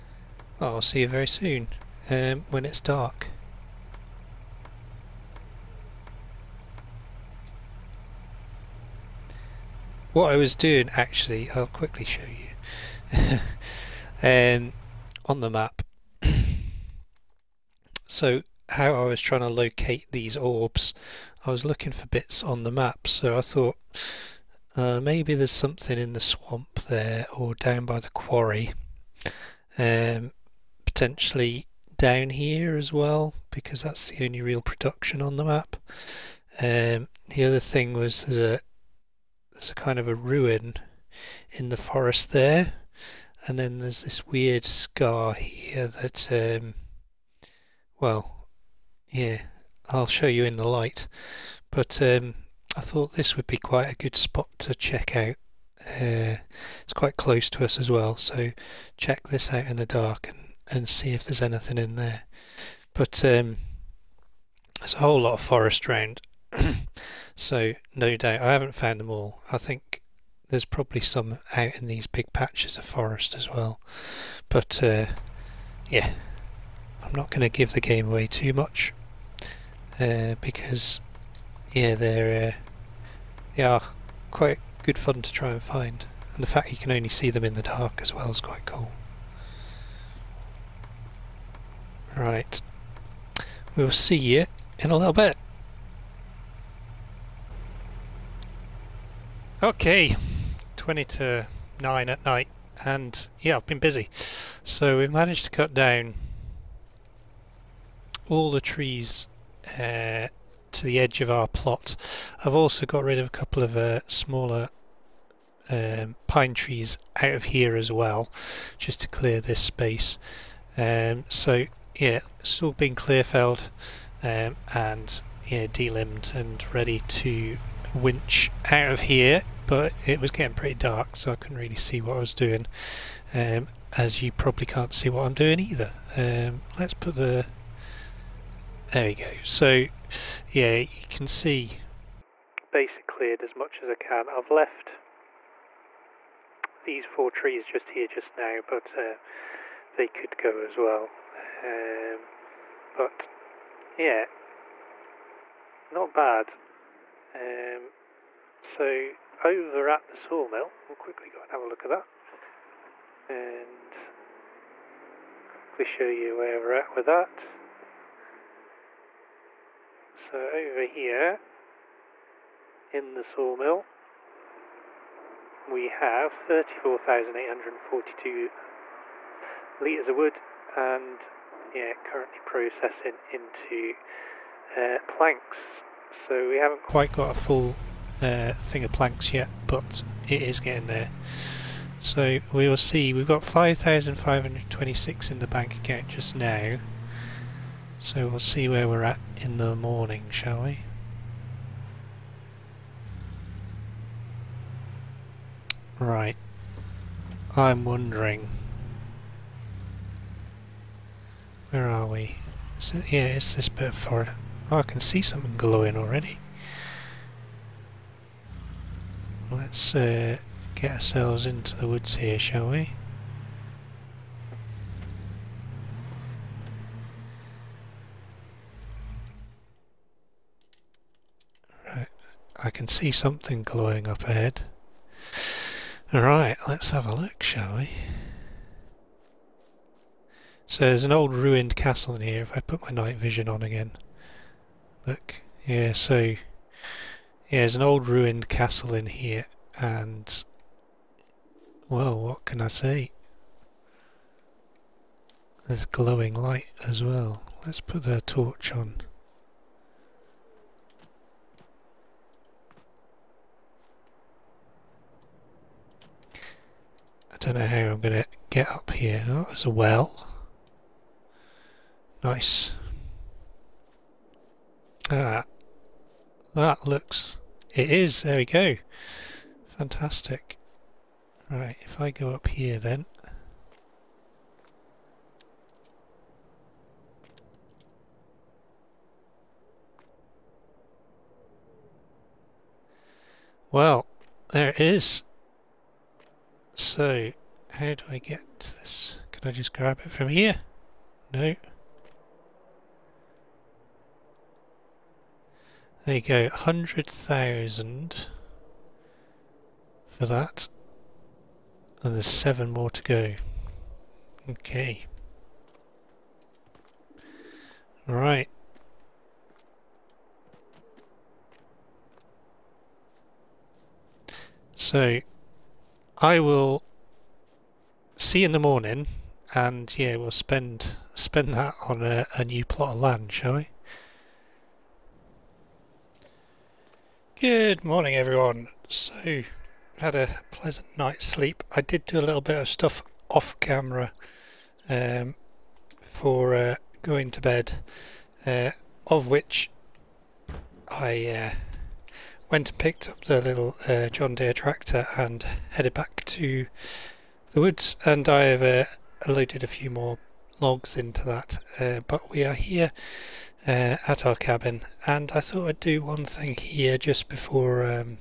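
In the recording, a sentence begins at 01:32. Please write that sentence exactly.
Right, we'll see you in a little bit.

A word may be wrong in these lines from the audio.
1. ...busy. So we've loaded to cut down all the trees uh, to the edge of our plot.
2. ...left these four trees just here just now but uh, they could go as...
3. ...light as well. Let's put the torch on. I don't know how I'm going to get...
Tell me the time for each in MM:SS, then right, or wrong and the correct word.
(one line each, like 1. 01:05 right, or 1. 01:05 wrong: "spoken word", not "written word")
1. 01:43 wrong: "managed", not "loaded"
2. 02:24 right
3. 04:16 right.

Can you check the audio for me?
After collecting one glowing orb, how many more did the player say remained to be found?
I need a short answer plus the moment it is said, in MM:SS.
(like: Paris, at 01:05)
7, at 05:12.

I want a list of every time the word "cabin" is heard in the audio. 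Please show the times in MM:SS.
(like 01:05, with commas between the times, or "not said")
06:04.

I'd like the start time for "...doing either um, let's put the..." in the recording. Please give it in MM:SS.
02:15.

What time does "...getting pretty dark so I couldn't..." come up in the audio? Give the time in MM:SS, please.
02:10.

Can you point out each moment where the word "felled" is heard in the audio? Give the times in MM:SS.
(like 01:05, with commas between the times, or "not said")
02:03.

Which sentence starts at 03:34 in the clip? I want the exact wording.
Oh, I can see something glowing already.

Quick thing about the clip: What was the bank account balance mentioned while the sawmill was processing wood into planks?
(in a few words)
5526.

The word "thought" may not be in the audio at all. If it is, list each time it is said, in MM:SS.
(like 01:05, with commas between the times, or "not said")
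00:23, 00:52, 06:05.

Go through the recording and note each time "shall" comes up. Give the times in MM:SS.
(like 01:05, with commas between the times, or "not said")
03:20, 03:42, 03:57, 05:33.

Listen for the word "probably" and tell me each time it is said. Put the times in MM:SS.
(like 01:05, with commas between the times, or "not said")
01:10, 02:14.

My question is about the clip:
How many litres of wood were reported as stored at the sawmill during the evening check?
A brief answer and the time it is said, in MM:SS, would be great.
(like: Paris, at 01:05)
34,842, at 02:56.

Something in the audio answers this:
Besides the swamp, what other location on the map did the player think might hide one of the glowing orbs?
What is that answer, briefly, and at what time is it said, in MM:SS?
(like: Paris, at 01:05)
The quarry, at 00:27.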